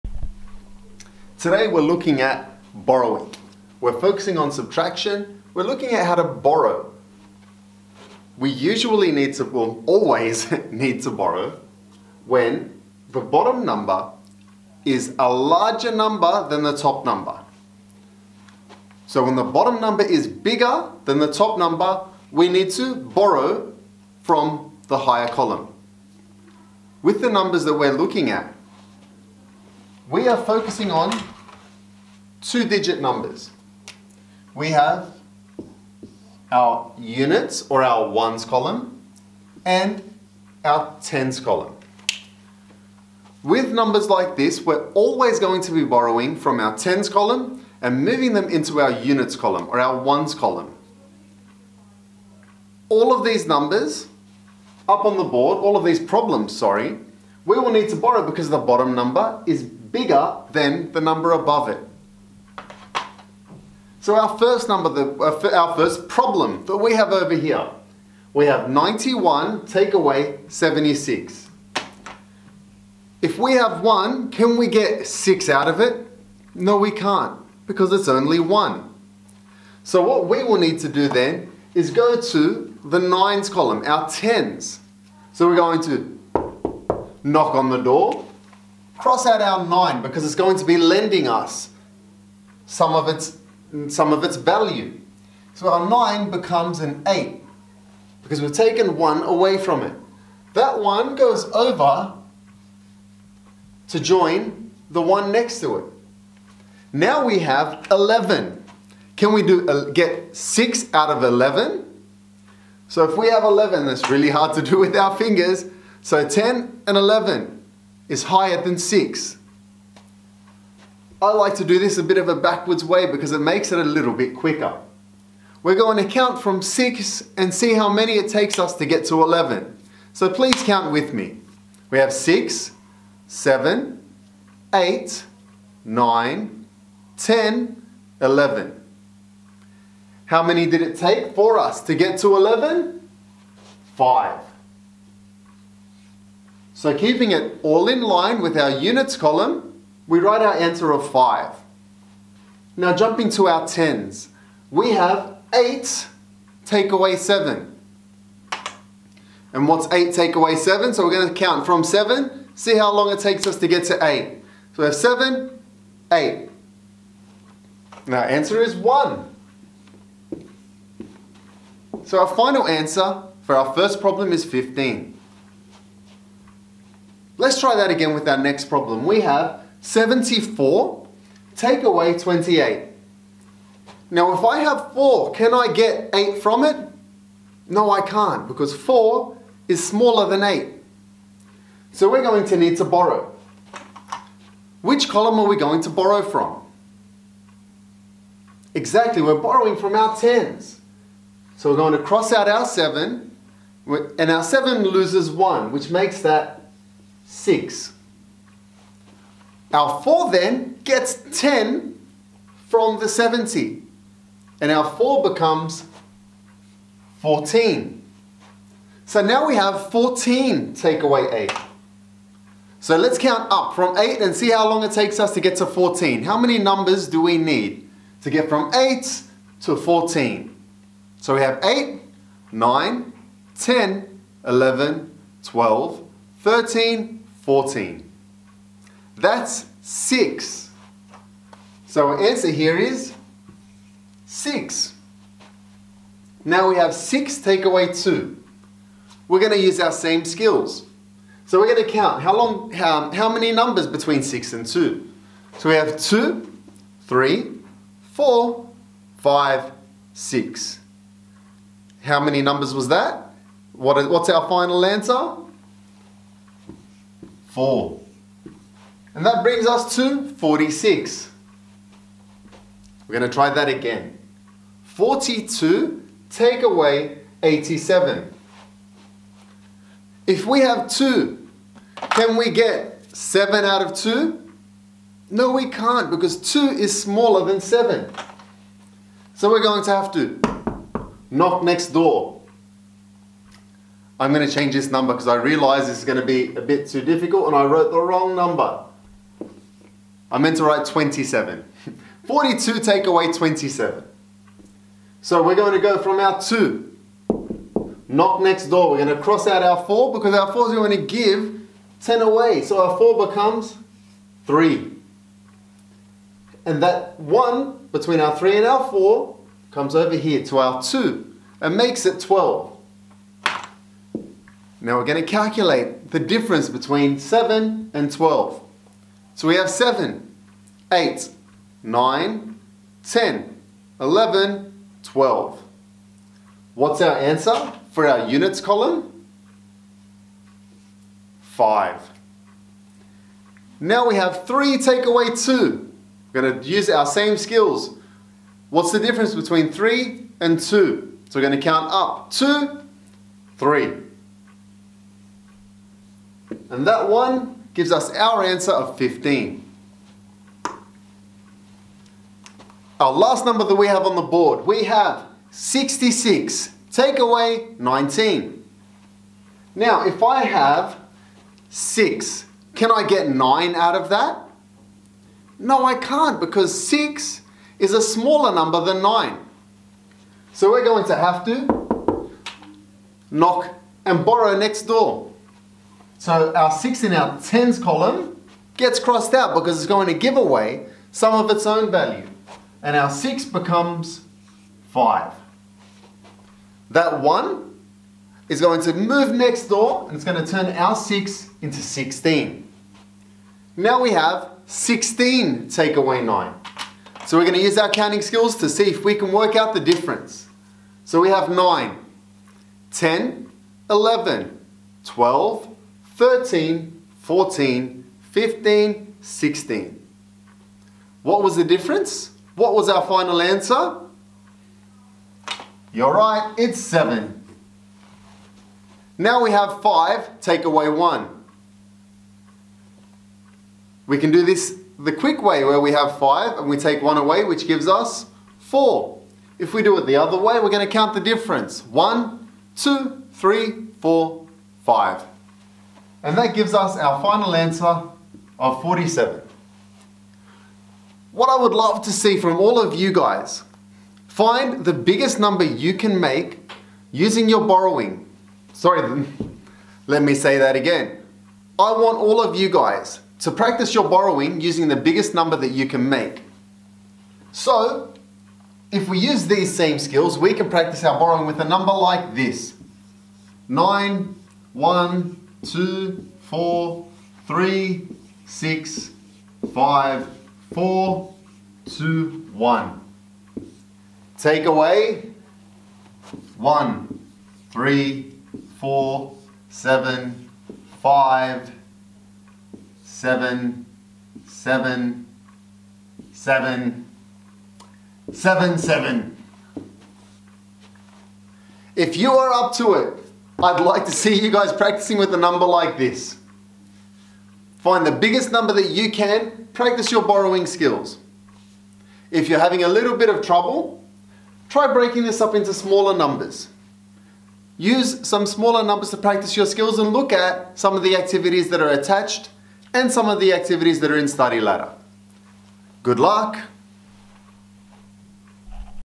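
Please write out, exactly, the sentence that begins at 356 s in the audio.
And that one gives us our answer of 15.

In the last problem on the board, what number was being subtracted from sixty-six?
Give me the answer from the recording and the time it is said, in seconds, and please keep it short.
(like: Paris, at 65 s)
19, at 367 s.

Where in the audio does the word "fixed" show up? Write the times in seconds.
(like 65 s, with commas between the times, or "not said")
not said.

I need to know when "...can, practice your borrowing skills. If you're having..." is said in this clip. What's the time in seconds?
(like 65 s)
509 s.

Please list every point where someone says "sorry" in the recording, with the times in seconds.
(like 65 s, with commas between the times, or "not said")
56 s, 458 s.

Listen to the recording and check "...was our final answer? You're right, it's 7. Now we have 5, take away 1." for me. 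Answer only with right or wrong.
right.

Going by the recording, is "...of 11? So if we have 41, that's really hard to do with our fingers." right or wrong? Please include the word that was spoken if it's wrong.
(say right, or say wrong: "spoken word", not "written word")
wrong: "11", not "41".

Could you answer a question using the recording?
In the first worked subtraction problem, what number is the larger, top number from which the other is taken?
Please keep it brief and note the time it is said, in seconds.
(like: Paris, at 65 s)
91, at 68 s.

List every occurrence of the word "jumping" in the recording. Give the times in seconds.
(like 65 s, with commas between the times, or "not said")
152 s.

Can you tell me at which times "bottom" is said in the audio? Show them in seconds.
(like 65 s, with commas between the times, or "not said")
13 s, 19 s, 58 s.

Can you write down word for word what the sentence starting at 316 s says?
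And that 1 between our 3 and our 4 comes over here to our 2 and makes it 12.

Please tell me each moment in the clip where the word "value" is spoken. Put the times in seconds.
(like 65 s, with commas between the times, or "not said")
94 s, 391 s.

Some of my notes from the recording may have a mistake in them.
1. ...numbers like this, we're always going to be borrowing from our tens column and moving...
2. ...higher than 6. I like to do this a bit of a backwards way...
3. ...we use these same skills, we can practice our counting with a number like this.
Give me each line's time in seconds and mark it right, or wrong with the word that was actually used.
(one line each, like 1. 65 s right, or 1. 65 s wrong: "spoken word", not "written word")
1. 43 s right
2. 118 s right
3. 469 s wrong: "borrowing", not "counting".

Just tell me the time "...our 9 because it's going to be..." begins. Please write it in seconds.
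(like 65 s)
89 s.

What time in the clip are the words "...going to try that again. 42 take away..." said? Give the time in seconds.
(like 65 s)
273 s.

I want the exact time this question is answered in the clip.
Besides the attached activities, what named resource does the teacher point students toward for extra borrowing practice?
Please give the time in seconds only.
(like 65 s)
524 s.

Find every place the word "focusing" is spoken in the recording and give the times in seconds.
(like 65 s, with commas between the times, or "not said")
3 s, 30 s.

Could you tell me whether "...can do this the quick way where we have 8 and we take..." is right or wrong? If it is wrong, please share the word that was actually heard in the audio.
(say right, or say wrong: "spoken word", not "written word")
wrong: "5", not "8".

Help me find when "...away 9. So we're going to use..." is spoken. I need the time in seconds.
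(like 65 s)
405 s.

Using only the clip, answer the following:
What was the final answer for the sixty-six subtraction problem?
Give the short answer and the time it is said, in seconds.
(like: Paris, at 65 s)
47, at 448 s.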